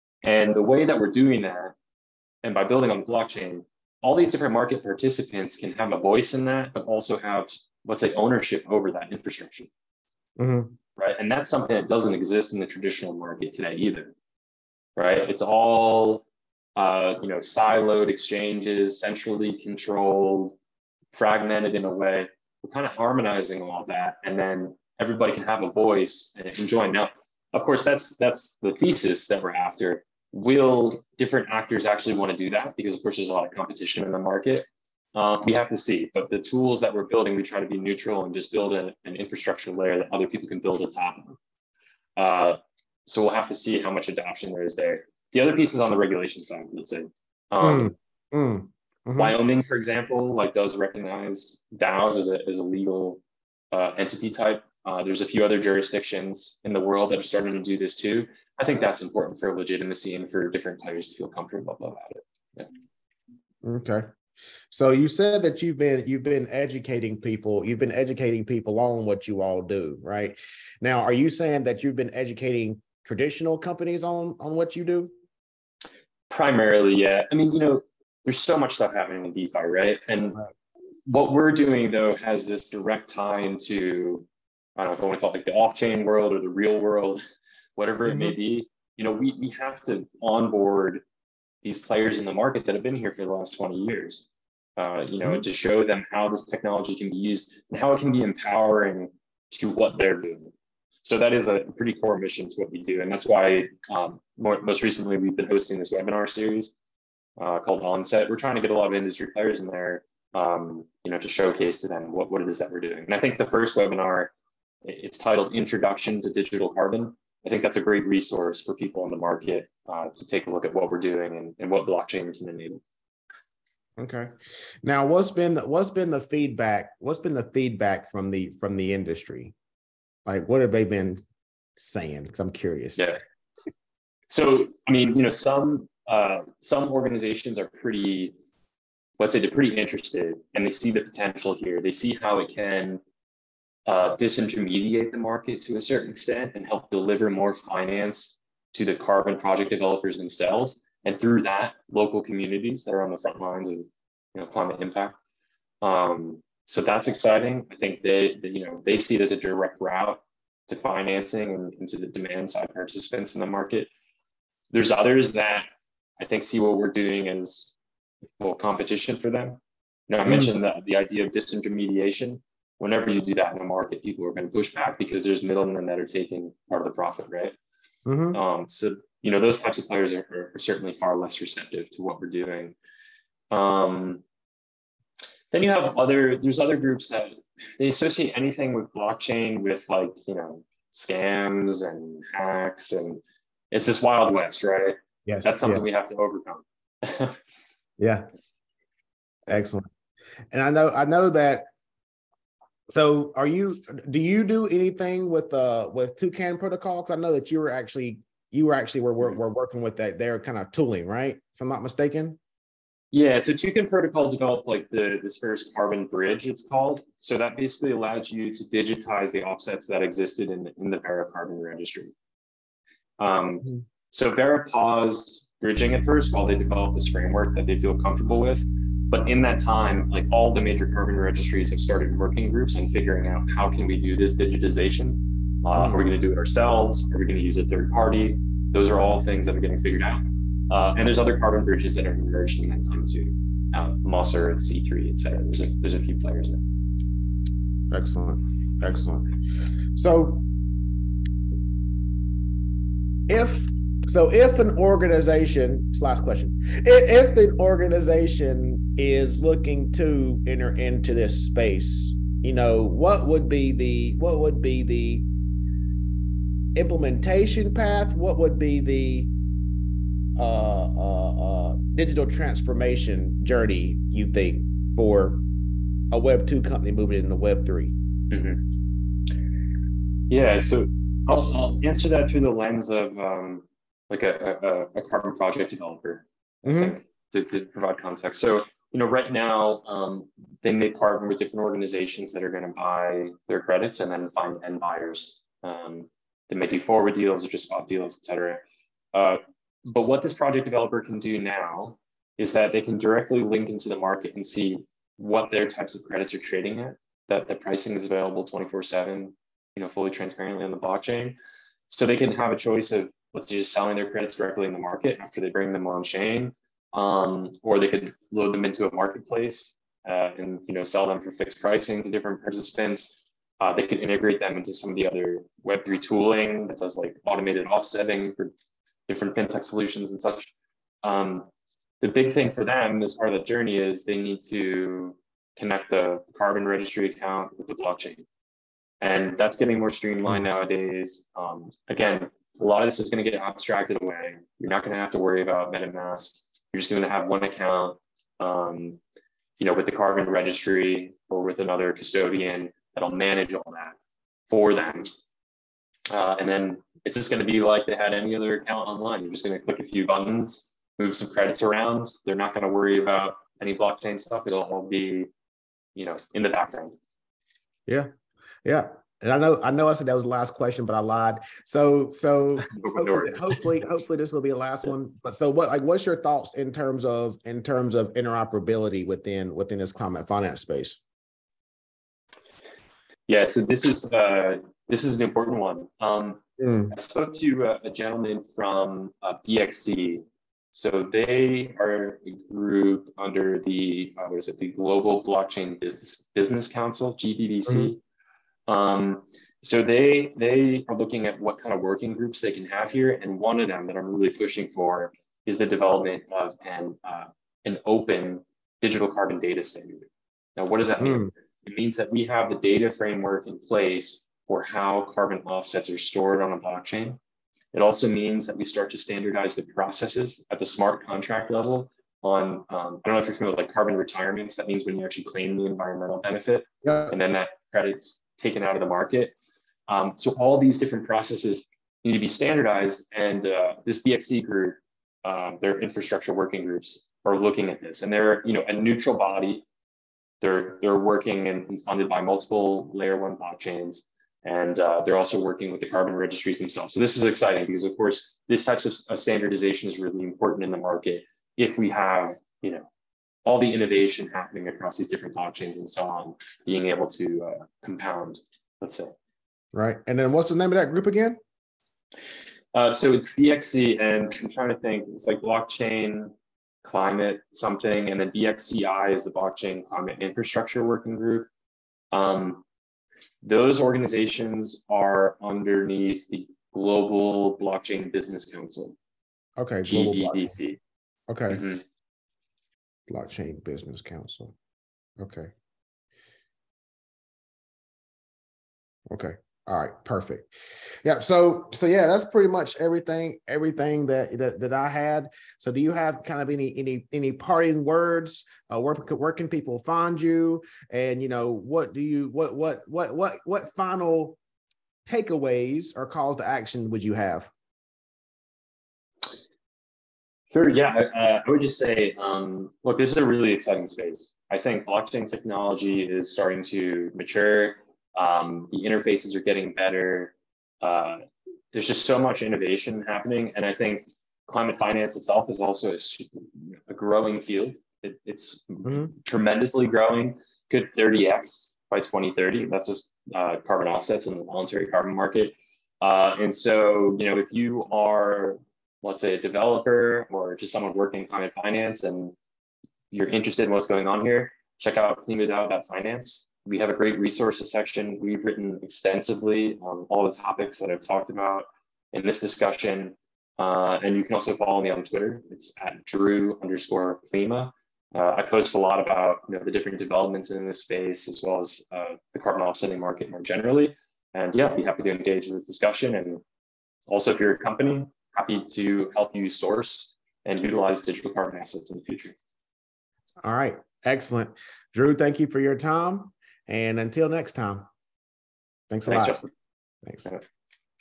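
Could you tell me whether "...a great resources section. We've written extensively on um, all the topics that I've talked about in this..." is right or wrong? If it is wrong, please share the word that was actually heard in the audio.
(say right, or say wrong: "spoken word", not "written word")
right.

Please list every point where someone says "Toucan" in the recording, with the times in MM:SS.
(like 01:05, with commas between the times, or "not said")
03:26, 03:33.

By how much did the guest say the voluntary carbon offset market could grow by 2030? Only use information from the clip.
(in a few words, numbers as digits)
30x.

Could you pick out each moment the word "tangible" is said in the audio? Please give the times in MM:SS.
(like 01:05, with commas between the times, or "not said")
not said.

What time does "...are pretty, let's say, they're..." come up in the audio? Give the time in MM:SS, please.
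02:17.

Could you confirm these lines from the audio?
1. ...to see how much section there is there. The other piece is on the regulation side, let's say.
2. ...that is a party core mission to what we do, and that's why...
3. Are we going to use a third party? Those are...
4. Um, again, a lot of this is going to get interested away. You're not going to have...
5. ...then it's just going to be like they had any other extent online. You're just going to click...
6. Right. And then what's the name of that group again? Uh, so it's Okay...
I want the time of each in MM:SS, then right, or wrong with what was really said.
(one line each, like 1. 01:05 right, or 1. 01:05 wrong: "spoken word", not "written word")
1. 00:43 wrong: "adoption", not "section"
2. 01:41 wrong: "pretty", not "party"
3. 03:57 right
4. 05:41 wrong: "abstracted", not "interested"
5. 05:56 wrong: "account", not "extent"
6. 07:39 wrong: "BXC", not "Okay".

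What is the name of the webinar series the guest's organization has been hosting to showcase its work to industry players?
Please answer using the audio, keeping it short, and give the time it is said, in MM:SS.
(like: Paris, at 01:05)
Onset, at 01:47.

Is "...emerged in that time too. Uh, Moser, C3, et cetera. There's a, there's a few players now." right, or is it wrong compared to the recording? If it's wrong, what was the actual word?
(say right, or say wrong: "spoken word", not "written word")
right.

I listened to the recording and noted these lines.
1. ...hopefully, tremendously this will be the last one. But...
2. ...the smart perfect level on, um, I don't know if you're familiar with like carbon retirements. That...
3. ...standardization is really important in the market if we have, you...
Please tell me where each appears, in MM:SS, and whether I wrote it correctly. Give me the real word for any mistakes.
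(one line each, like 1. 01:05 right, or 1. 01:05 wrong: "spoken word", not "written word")
1. 06:13 wrong: "hopefully", not "tremendously"
2. 07:00 wrong: "contract", not "perfect"
3. 07:29 right.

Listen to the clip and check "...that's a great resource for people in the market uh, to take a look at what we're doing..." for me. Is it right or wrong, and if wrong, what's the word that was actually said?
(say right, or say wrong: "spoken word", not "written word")
right.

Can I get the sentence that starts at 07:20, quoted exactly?
They're, they're working and funded by multiple layer one blockchains.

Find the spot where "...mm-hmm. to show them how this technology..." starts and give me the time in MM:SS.
01:35.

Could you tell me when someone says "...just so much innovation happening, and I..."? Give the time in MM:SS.
08:41.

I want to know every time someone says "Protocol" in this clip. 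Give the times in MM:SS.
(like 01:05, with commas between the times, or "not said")
03:26, 03:33.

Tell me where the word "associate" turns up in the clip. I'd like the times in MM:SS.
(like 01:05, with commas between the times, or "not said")
03:07.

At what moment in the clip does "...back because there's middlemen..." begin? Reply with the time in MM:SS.
02:54.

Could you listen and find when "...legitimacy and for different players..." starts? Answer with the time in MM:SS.
00:59.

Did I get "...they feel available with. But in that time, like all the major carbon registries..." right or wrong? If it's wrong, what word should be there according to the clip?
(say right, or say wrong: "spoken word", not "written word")
wrong: "comfortable", not "available".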